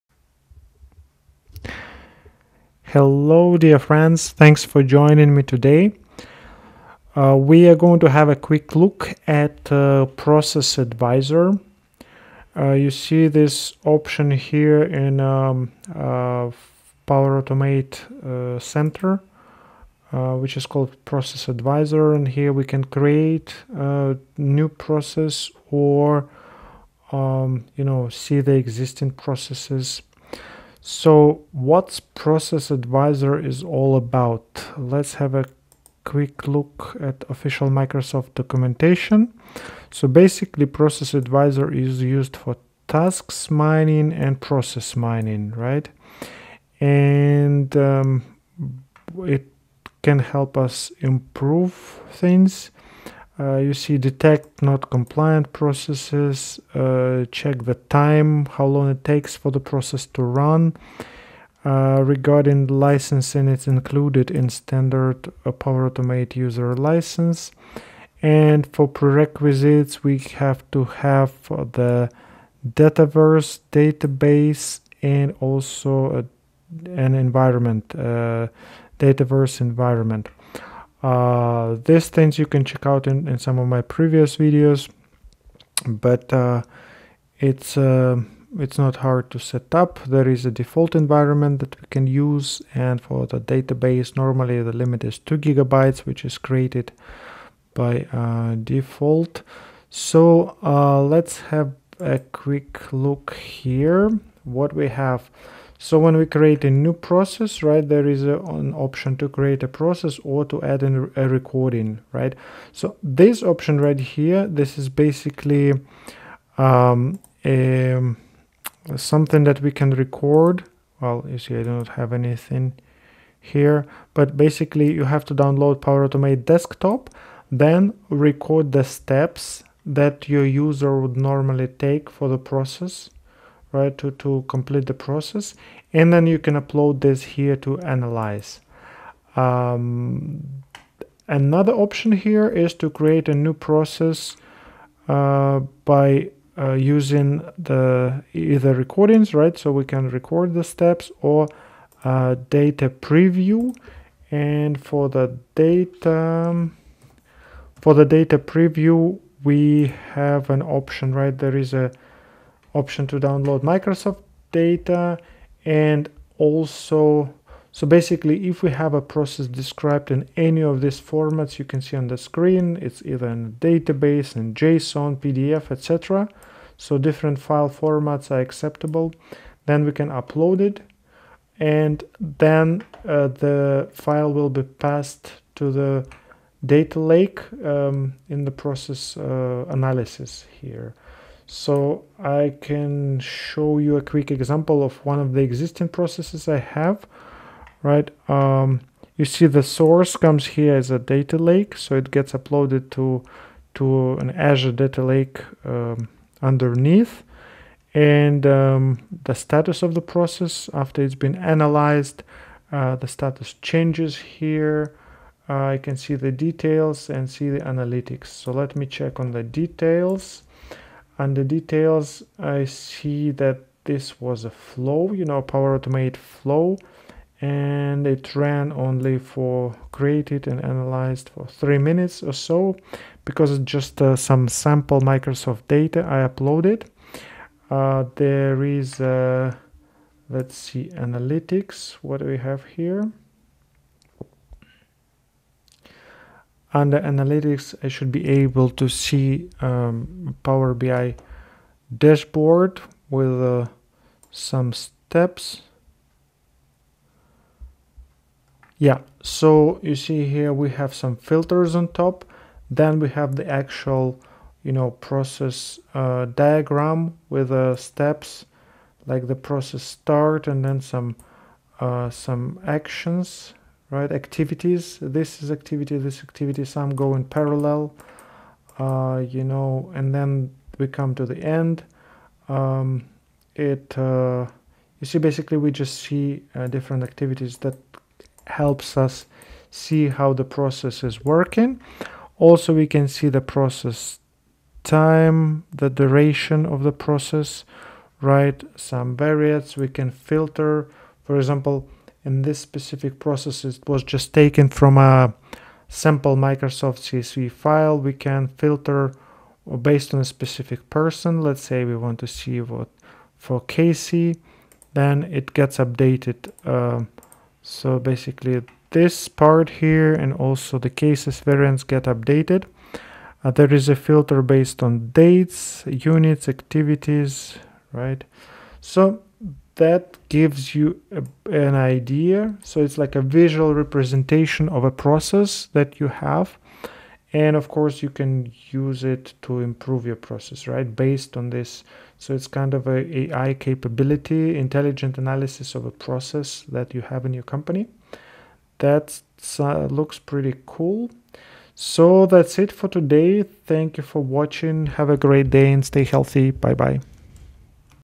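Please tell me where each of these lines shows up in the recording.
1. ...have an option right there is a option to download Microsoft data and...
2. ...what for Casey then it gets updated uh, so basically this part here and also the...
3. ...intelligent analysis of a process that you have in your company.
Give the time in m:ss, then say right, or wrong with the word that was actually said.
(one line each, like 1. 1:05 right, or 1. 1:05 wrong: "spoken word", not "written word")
1. 2:40 right
2. 5:12 right
3. 5:44 right.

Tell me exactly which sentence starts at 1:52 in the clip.
So this option right here, this is basically um, a, something that we can record.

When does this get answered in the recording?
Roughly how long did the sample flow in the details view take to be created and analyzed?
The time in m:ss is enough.
3:51.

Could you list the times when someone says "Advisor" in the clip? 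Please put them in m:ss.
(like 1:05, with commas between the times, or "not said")
0:10, 0:21, 0:32, 0:41.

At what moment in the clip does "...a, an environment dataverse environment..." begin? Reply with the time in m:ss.
1:16.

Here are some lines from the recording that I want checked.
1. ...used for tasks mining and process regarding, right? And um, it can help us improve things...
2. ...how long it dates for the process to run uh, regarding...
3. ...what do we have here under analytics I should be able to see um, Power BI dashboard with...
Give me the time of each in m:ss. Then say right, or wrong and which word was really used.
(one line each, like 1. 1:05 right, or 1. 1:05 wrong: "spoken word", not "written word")
1. 0:42 wrong: "mining", not "regarding"
2. 0:58 wrong: "takes", not "dates"
3. 4:02 right.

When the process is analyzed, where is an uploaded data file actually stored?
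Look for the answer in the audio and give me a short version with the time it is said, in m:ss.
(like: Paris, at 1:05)
Azure data lake, at 3:24.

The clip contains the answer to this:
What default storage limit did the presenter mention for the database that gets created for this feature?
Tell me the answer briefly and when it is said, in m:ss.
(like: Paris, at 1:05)
2 gigabytes, at 1:35.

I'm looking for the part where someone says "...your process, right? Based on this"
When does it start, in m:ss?
5:40.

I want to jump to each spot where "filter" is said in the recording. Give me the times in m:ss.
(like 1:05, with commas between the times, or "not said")
4:21, 5:00, 5:08, 5:23.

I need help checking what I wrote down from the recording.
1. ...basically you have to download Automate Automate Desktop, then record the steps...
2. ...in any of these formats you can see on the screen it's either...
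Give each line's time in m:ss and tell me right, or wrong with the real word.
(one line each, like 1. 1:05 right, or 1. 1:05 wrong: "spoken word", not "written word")
1. 2:04 wrong: "Power", not "Automate"
2. 2:50 right.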